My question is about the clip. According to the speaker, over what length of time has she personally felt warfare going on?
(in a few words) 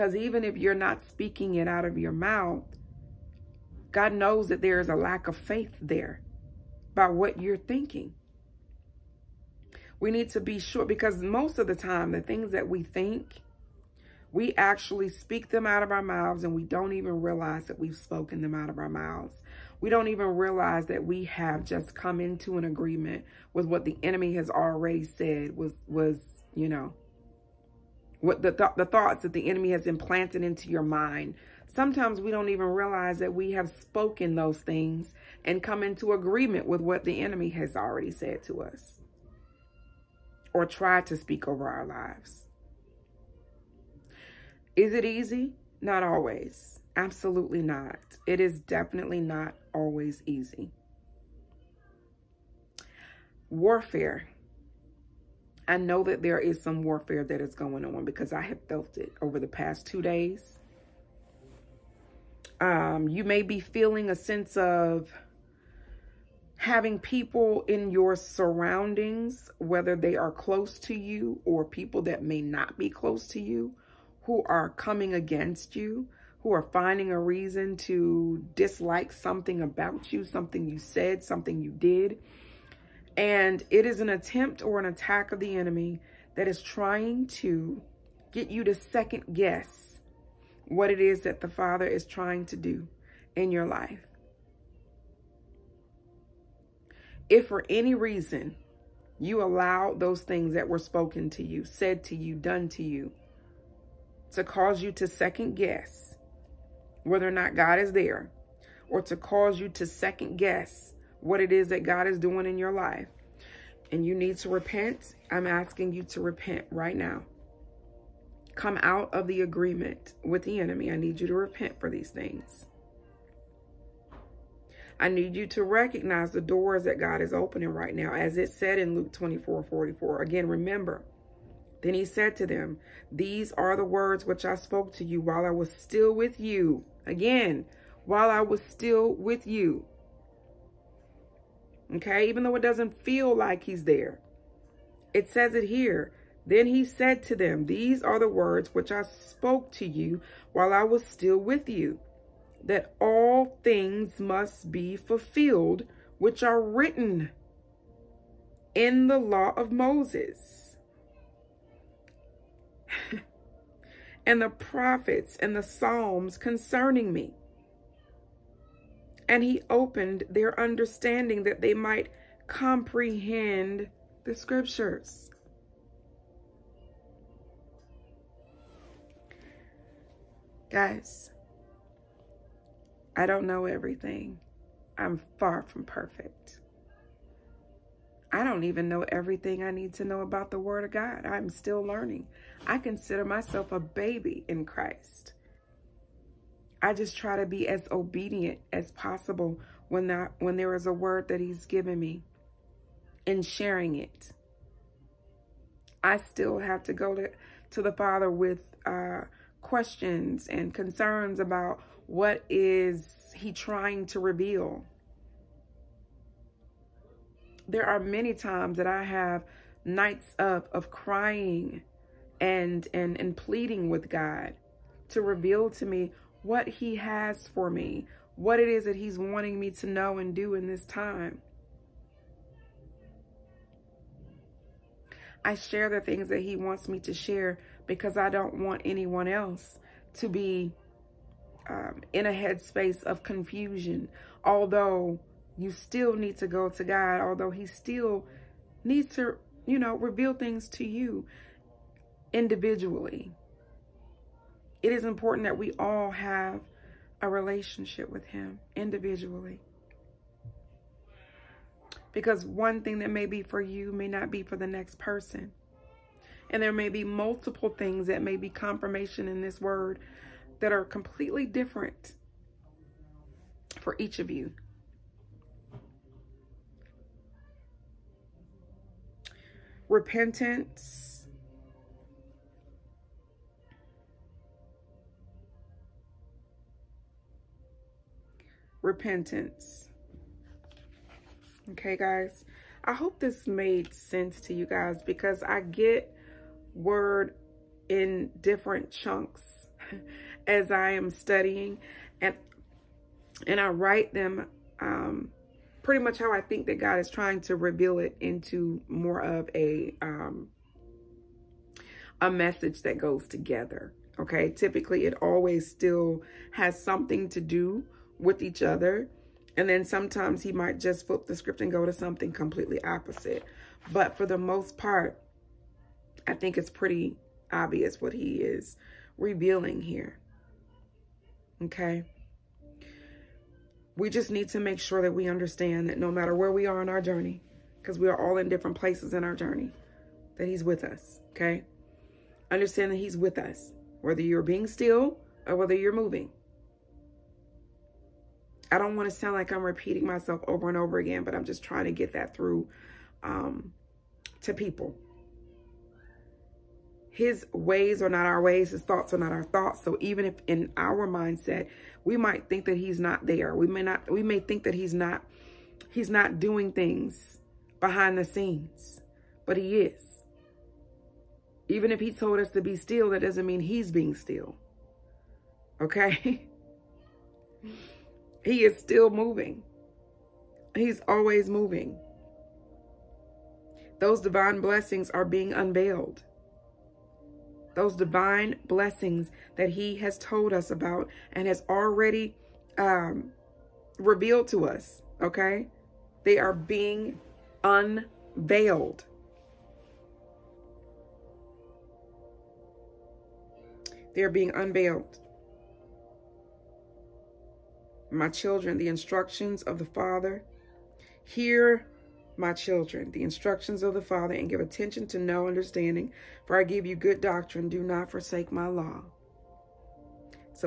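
two days.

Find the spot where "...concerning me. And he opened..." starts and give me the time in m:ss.
2:46.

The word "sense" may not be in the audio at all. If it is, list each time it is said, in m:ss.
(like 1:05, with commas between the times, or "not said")
1:04, 4:53.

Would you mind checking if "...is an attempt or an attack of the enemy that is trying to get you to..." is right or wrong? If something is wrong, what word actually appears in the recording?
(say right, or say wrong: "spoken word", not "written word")
right.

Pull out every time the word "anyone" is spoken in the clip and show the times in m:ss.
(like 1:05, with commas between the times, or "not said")
3:58.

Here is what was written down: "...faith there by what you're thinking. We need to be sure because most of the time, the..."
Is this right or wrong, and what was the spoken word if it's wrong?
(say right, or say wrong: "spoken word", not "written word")
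right.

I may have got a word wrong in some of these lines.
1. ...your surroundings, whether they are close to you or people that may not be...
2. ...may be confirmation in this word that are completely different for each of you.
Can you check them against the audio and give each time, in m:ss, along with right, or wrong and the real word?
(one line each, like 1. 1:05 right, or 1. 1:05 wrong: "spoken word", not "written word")
1. 1:07 right
2. 4:28 right.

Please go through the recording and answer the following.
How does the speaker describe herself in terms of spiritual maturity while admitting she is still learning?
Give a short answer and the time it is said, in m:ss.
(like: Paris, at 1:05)
a baby in Christ, at 3:13.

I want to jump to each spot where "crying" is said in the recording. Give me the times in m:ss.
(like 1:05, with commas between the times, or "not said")
3:40.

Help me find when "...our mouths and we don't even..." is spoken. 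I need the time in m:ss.
0:15.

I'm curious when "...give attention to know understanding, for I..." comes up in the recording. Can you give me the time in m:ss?
6:54.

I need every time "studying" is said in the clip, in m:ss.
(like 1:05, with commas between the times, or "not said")
5:01.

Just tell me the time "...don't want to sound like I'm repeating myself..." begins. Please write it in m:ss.
5:48.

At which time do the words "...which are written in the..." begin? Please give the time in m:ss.
2:36.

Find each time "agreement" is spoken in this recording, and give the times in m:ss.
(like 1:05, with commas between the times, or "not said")
0:22, 0:36, 1:59.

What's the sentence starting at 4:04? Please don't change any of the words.
Although you still need to go to God, although he still needs to, you know, reveal things to you individually.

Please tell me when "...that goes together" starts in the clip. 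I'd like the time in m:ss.
5:12.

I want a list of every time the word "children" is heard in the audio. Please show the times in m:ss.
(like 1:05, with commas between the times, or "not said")
6:48, 6:52.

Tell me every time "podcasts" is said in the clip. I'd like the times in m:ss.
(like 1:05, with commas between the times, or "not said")
not said.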